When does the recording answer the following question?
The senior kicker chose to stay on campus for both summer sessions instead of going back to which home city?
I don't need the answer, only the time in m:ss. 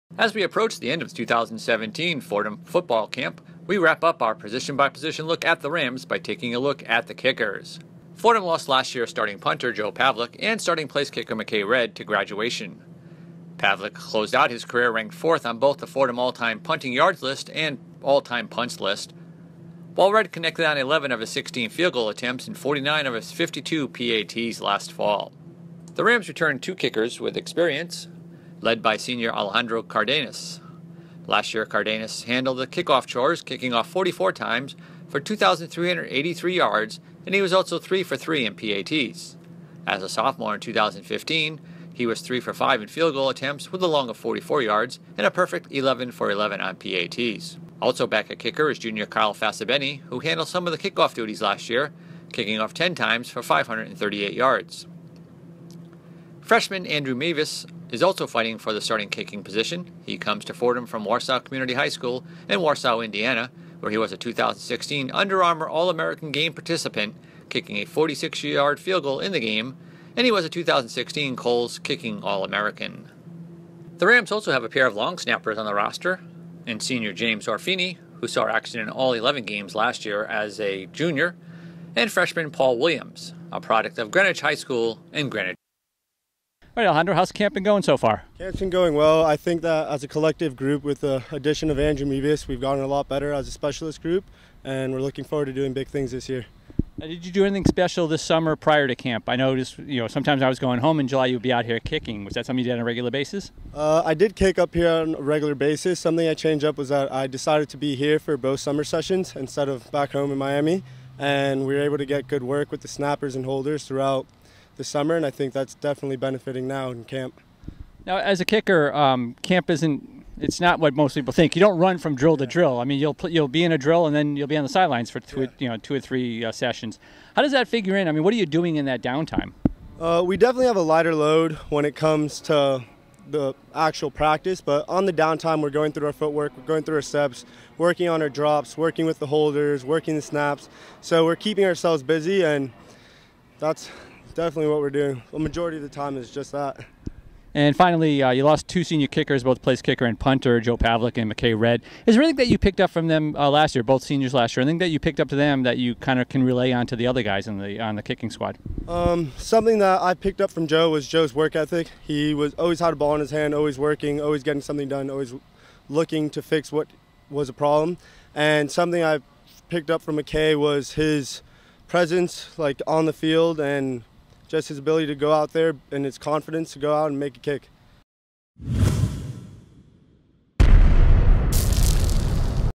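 1:50.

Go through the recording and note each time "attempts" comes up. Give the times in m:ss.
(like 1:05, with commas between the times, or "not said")
0:22, 0:43.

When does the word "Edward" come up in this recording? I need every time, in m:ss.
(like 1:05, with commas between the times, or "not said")
not said.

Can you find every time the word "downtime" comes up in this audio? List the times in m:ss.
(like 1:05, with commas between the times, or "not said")
2:09, 2:15.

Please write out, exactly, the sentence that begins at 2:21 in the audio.
So we're keeping ourselves busy, and that's definitely what we're doing.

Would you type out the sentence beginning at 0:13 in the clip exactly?
Pavlik closed out his career ranked fourth on both the Fordham all time punting yards list and all time punts list.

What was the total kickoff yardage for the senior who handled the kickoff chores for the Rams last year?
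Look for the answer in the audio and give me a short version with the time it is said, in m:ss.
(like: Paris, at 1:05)
2,383 yards, at 0:35.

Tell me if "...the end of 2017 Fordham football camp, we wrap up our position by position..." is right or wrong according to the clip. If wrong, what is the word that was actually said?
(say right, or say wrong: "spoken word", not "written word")
right.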